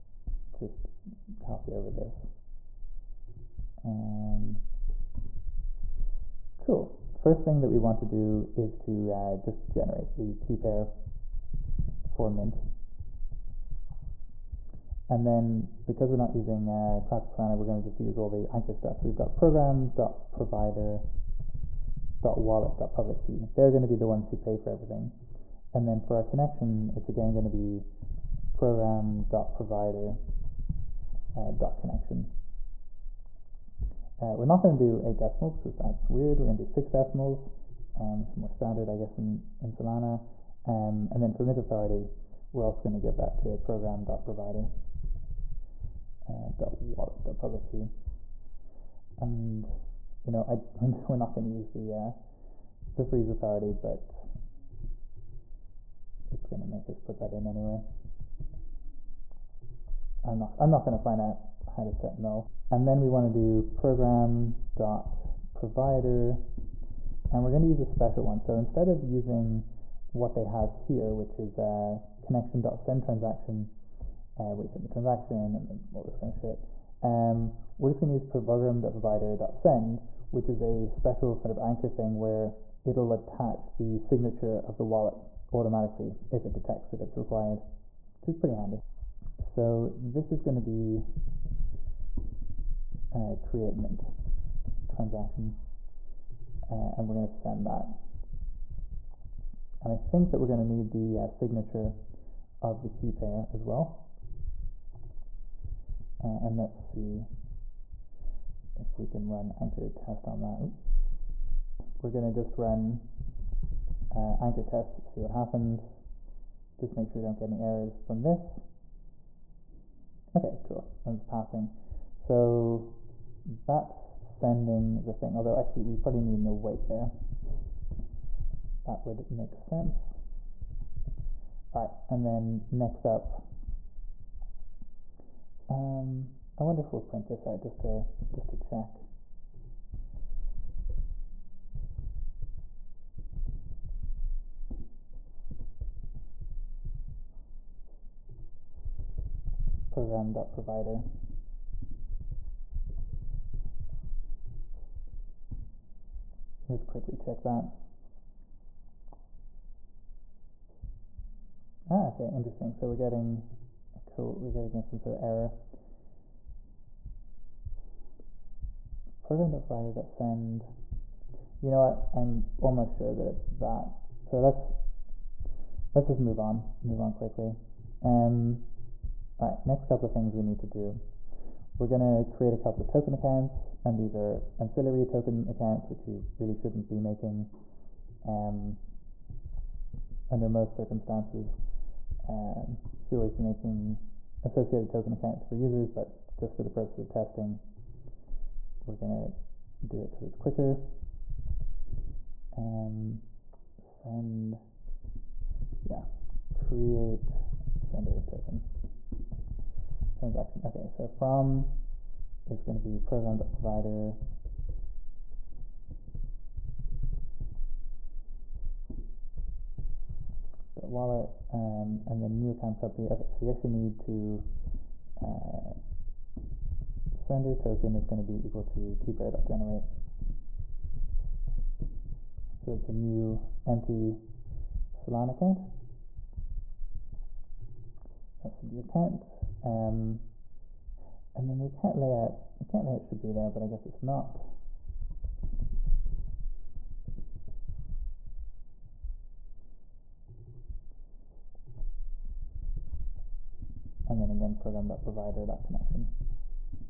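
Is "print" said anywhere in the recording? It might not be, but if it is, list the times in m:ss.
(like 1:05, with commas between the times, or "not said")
2:17.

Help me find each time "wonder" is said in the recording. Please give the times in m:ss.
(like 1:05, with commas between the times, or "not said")
2:16.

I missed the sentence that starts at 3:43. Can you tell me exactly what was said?
Okay, so we actually need to uh, sender token is going to be equal to keypair.generate.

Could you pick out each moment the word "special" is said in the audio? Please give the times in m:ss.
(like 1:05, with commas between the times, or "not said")
1:07, 1:20.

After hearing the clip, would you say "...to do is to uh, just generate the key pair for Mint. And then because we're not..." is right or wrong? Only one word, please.
right.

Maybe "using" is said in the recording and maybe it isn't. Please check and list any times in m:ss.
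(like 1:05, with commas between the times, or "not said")
0:16, 1:09.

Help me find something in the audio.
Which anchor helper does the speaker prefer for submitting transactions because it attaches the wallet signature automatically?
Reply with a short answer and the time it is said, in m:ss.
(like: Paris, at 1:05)
program.provider.send, at 1:18.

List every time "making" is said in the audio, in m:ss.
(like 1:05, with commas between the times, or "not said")
3:06, 3:13.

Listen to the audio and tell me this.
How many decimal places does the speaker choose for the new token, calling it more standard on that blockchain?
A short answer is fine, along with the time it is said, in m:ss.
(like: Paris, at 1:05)
6, at 0:36.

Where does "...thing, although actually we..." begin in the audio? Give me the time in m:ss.
2:05.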